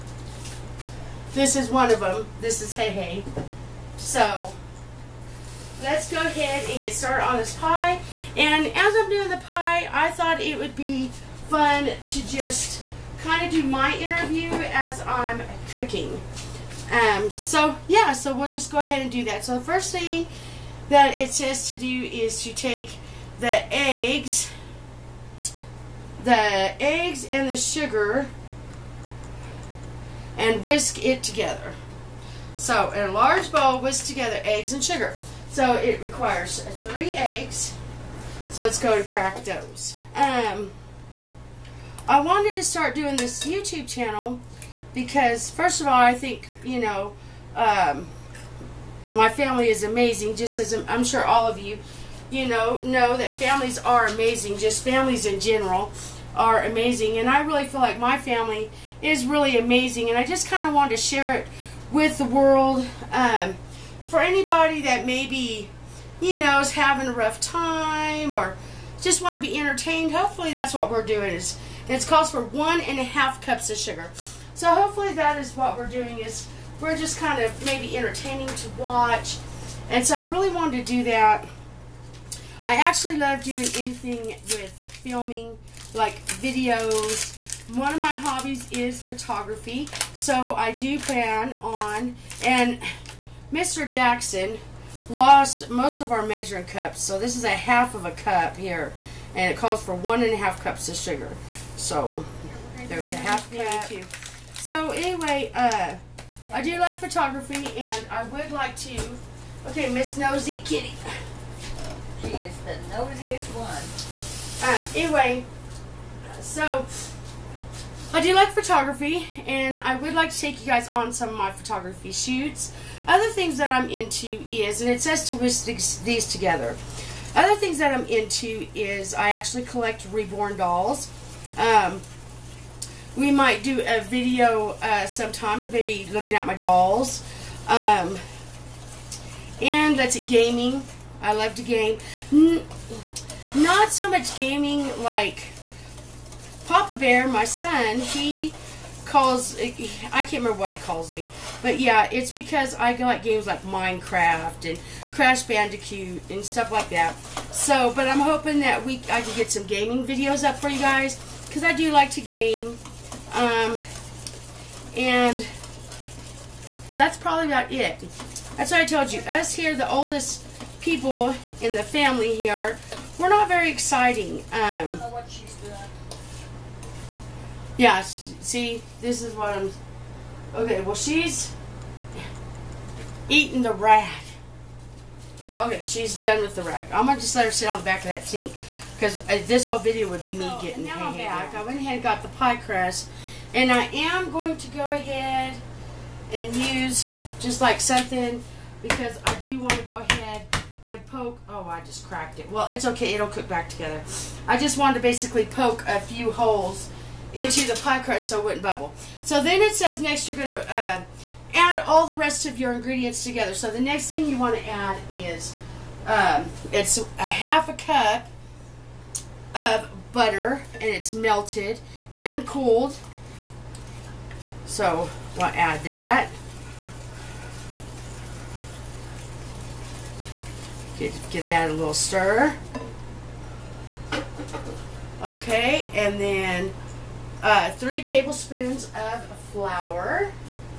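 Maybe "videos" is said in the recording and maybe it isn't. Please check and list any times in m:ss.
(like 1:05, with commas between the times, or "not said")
1:26, 2:13, 2:40, 3:09.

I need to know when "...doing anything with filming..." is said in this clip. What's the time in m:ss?
1:23.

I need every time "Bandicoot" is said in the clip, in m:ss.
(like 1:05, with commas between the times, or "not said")
2:35.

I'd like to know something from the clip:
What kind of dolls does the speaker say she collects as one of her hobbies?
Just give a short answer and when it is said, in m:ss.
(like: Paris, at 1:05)
Reborn dolls, at 2:10.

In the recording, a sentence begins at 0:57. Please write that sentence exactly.
And I really feel like my family is really amazing.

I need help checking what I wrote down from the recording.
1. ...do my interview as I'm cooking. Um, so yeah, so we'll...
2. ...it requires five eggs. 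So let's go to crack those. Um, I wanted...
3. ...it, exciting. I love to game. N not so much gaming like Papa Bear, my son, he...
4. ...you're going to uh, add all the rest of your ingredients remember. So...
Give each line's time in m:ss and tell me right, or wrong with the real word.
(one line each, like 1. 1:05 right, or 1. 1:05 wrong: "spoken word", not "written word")
1. 0:13 right
2. 0:35 wrong: "three", not "five"
3. 2:20 wrong: "gaming", not "exciting"
4. 3:30 wrong: "together", not "remember".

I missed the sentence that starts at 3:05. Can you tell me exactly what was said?
Okay, she's done with the rag.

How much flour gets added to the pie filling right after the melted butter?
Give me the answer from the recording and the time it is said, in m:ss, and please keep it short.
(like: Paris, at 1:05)
3 tablespoons, at 3:57.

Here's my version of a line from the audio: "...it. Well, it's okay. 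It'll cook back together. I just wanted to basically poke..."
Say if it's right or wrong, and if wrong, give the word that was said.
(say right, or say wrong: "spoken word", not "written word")
right.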